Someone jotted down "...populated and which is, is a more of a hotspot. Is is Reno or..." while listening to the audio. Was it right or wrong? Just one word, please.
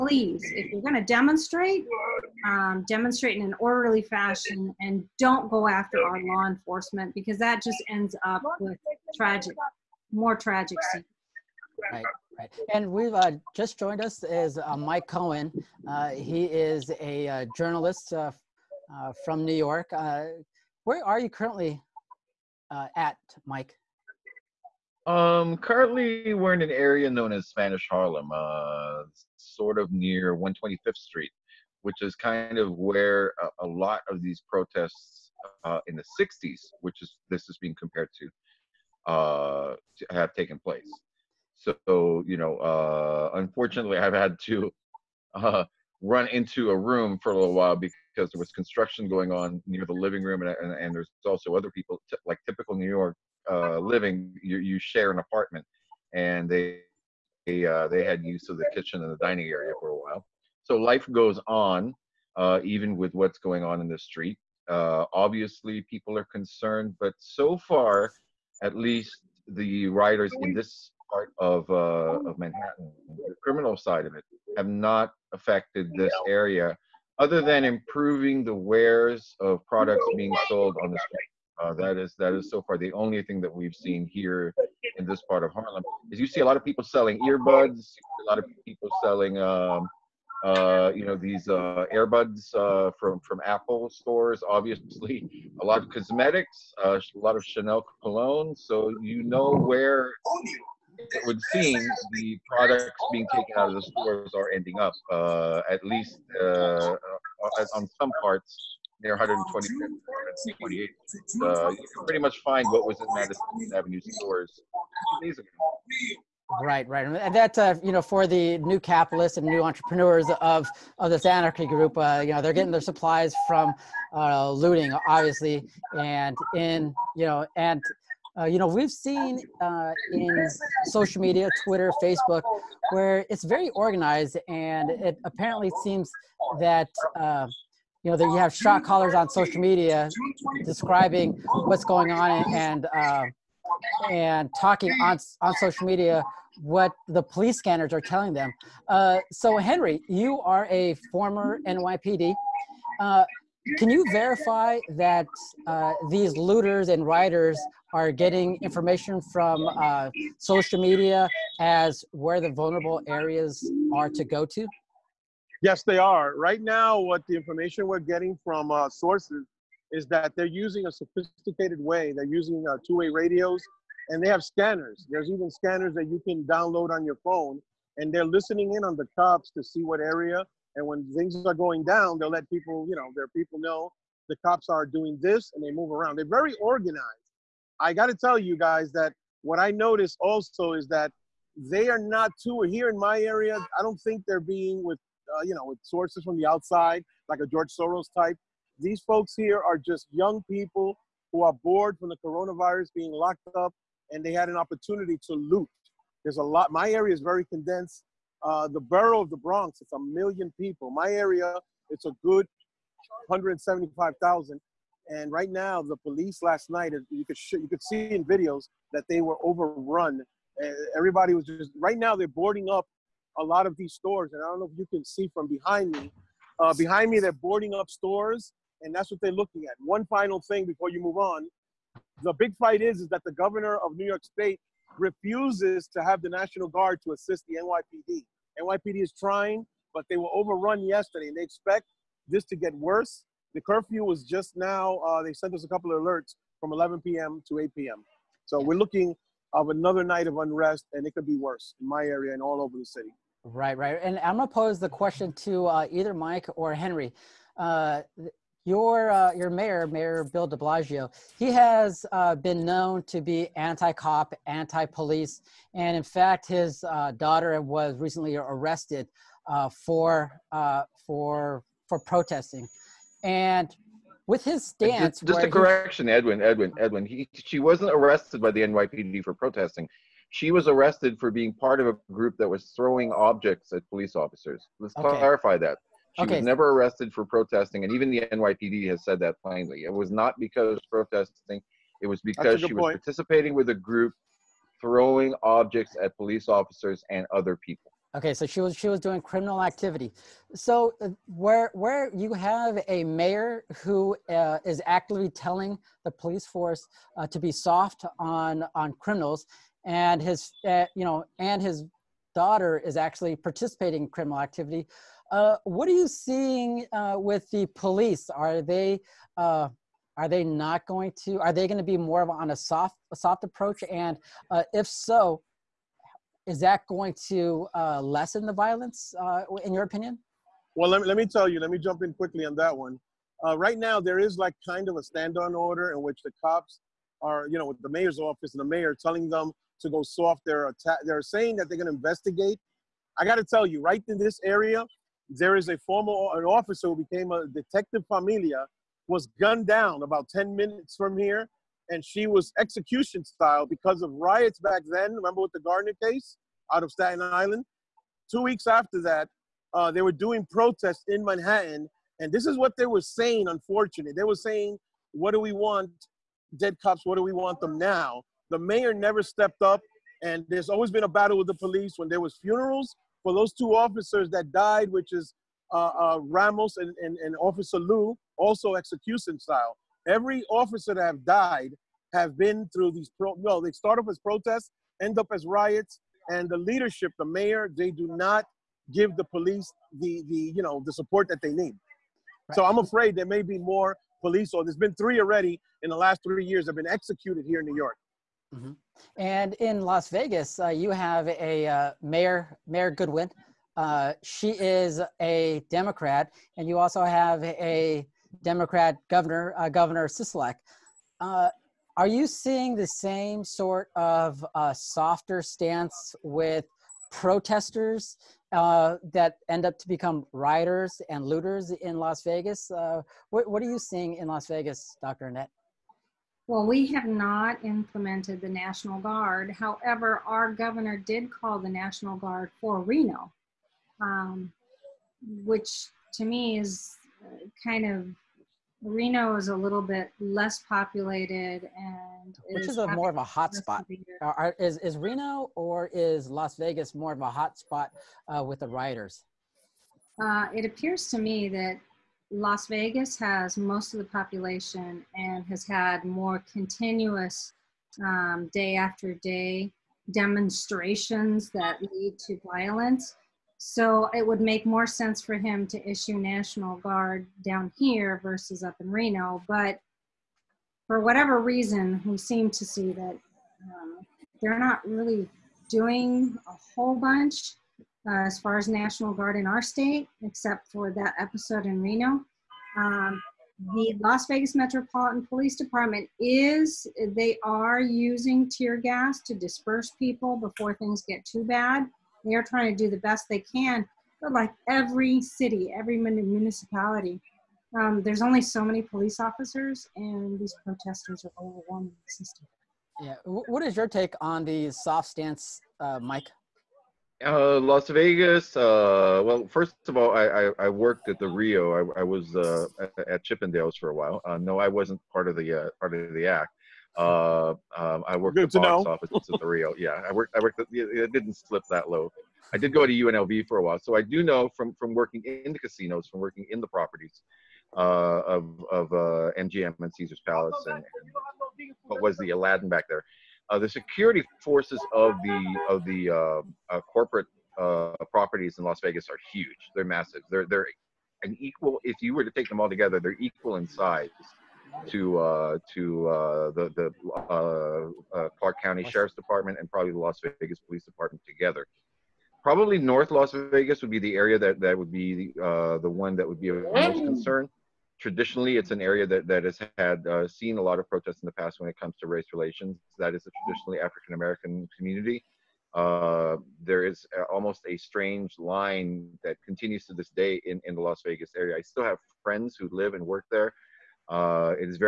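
right.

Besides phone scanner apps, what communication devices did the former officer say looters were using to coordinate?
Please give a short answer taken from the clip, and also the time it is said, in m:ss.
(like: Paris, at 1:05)
Two-way radios, at 2:52.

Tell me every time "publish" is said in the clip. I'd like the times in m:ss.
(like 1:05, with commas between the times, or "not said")
not said.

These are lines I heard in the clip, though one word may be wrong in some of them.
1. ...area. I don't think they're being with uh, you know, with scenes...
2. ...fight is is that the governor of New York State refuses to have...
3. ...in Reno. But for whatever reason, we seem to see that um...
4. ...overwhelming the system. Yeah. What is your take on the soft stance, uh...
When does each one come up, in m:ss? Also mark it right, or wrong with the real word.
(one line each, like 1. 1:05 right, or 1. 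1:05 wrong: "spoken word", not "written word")
1. 3:13 wrong: "sources", not "scenes"
2. 3:52 right
3. 7:48 right
4. 8:21 right.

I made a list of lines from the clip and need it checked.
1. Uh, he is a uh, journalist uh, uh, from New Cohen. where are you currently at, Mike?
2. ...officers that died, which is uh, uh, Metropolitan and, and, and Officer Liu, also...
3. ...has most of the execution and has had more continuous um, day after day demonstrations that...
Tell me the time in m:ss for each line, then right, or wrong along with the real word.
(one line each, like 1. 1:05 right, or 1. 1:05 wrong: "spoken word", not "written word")
1. 0:15 wrong: "York", not "Cohen"
2. 6:13 wrong: "Ramos", not "Metropolitan"
3. 7:33 wrong: "population", not "execution".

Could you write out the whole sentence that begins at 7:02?
Uh, what, what, are you seeing in Las Vegas, Dr.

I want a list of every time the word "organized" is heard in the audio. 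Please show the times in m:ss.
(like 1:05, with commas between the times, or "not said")
2:13, 3:06.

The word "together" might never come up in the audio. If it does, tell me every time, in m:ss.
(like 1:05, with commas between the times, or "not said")
9:02, 9:11.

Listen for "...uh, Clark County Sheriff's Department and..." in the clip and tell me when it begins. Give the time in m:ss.
9:08.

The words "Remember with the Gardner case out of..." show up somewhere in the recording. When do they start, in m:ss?
5:55.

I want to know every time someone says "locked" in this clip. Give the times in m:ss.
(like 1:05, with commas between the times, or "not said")
3:23.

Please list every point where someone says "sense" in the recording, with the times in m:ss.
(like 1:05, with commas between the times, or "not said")
7:44.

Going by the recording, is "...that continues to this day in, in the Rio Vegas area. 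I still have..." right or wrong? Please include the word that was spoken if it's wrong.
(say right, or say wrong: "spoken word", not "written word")
wrong: "Las", not "Rio".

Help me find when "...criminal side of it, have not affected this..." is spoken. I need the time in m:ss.
1:13.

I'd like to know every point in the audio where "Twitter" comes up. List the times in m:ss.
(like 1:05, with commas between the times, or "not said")
2:11.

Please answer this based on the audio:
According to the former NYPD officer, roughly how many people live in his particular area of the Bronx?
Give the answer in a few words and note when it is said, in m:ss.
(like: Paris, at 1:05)
175,000, at 3:33.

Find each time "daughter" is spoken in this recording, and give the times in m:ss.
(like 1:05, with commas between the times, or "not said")
4:27, 5:12.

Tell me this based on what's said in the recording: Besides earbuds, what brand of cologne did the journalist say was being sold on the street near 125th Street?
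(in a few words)
Chanel.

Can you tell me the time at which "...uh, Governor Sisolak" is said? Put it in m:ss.
6:49.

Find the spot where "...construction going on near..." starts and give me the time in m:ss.
0:48.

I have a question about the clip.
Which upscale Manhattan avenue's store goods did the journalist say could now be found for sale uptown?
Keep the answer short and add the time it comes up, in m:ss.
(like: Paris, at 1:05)
Madison Avenue, at 1:53.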